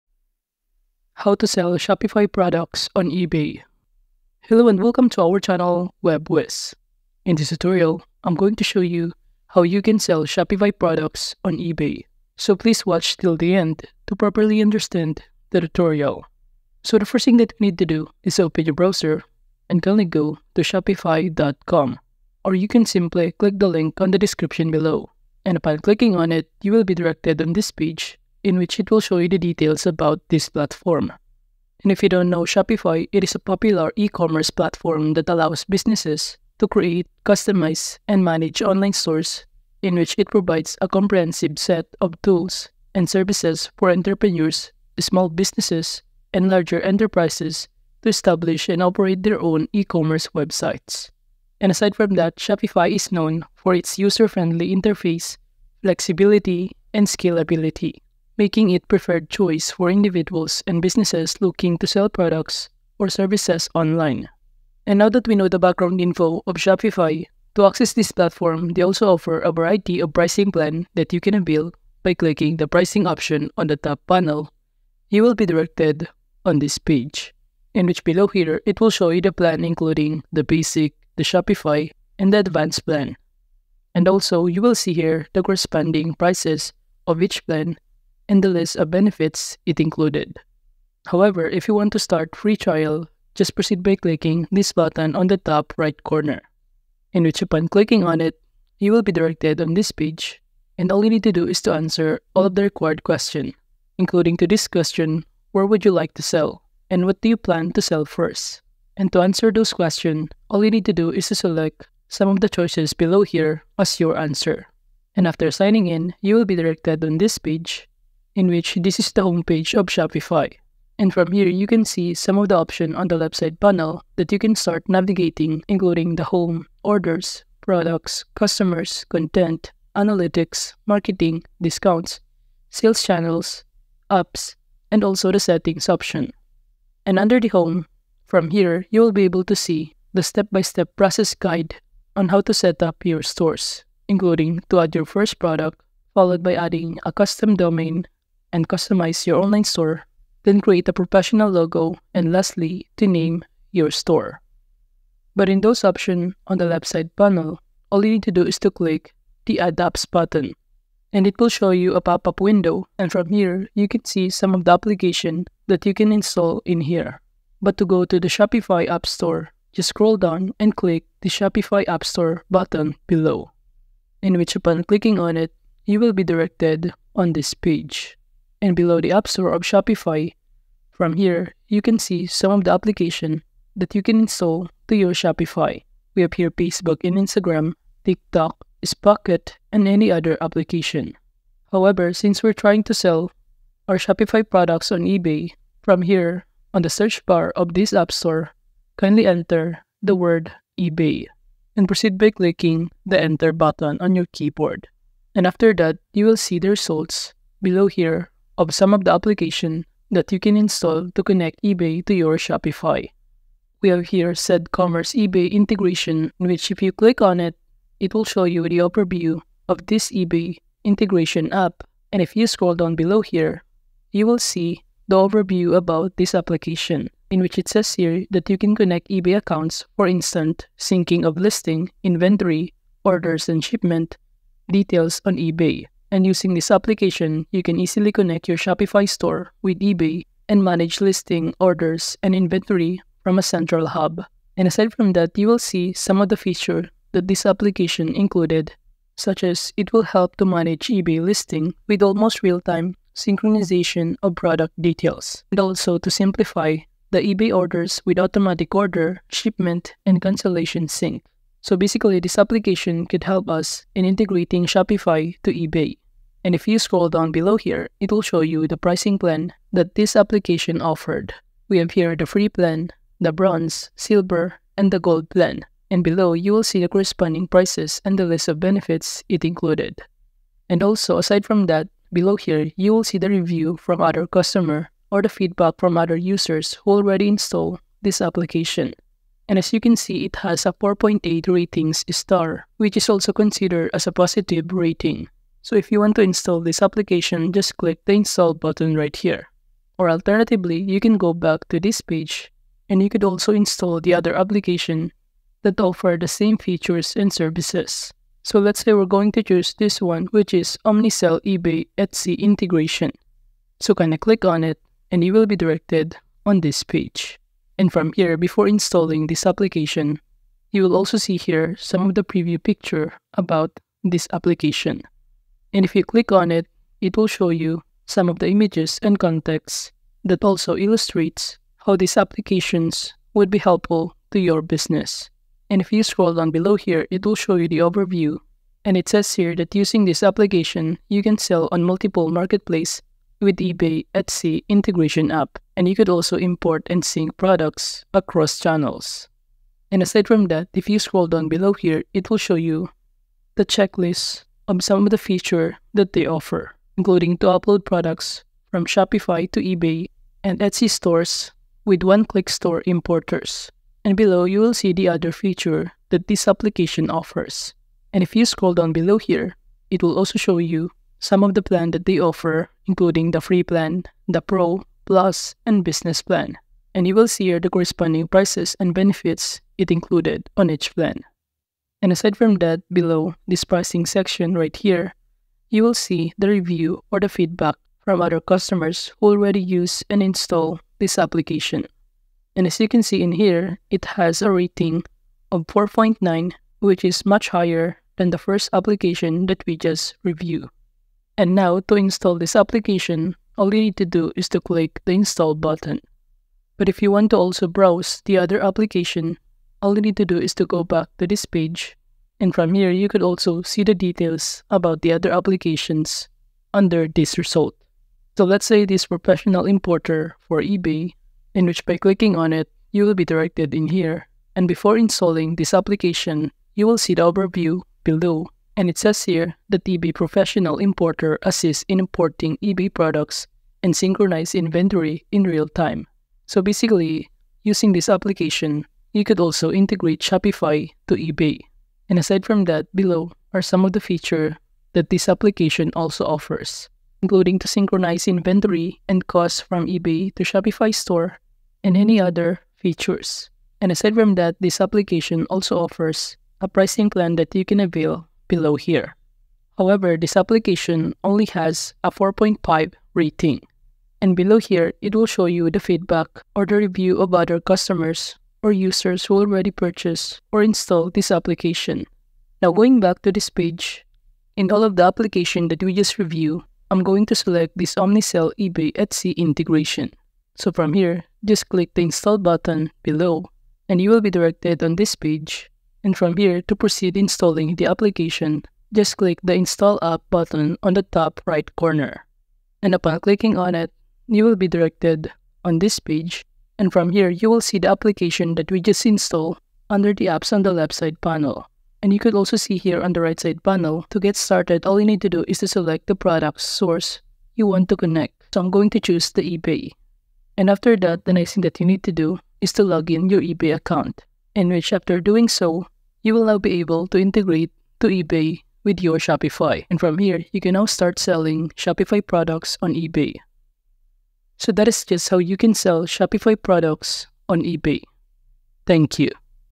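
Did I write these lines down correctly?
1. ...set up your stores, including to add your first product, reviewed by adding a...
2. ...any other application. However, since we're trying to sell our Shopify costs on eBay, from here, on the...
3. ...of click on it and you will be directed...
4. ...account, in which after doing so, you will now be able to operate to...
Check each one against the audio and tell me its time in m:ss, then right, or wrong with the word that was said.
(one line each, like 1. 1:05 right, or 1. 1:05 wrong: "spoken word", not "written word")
1. 2:22 wrong: "followed", not "reviewed"
2. 3:09 wrong: "products", not "costs"
3. 5:14 right
4. 8:33 wrong: "integrate", not "operate".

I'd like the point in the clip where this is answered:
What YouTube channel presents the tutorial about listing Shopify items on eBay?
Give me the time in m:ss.
0:06.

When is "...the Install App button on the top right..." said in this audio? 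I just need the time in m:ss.
8:09.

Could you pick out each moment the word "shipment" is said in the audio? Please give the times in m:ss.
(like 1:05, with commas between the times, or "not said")
3:53, 4:19.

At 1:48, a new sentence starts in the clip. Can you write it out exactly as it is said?
And to answer those questions, all you need to do is to select some of the choices below here as your answer.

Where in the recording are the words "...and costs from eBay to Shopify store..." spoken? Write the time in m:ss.
7:29.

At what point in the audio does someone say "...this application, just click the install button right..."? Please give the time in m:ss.
4:56.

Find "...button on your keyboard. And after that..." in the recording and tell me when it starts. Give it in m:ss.
3:23.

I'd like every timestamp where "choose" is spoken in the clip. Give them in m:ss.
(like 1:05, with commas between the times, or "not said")
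5:09, 8:28.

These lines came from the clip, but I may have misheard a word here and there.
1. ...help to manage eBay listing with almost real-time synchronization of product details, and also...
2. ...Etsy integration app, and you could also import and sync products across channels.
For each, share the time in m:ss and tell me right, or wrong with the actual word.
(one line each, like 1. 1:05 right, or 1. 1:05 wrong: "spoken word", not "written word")
1. 4:10 right
2. 5:44 right.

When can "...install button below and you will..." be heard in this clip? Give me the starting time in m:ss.
8:02.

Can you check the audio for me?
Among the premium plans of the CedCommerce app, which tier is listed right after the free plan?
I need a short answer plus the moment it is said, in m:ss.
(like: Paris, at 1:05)
Bronze, at 4:33.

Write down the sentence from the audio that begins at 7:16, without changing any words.
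So basically, using this application, you could also integrate Shopify to eBay.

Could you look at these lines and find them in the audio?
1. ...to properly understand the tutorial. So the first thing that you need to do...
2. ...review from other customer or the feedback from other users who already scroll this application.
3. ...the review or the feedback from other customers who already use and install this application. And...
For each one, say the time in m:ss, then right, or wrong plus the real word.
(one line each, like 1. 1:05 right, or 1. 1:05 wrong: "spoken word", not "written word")
1. 0:14 right
2. 4:43 wrong: "install", not "scroll"
3. 6:26 right.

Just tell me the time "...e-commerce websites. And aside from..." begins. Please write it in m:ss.
0:49.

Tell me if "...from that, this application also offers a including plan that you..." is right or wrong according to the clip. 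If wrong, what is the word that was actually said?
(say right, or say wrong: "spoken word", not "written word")
wrong: "pricing", not "including".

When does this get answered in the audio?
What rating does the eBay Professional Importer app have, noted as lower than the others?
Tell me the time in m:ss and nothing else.
7:42.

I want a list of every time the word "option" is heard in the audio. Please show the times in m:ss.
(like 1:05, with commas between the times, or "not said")
1:13, 2:02, 2:15, 2:35.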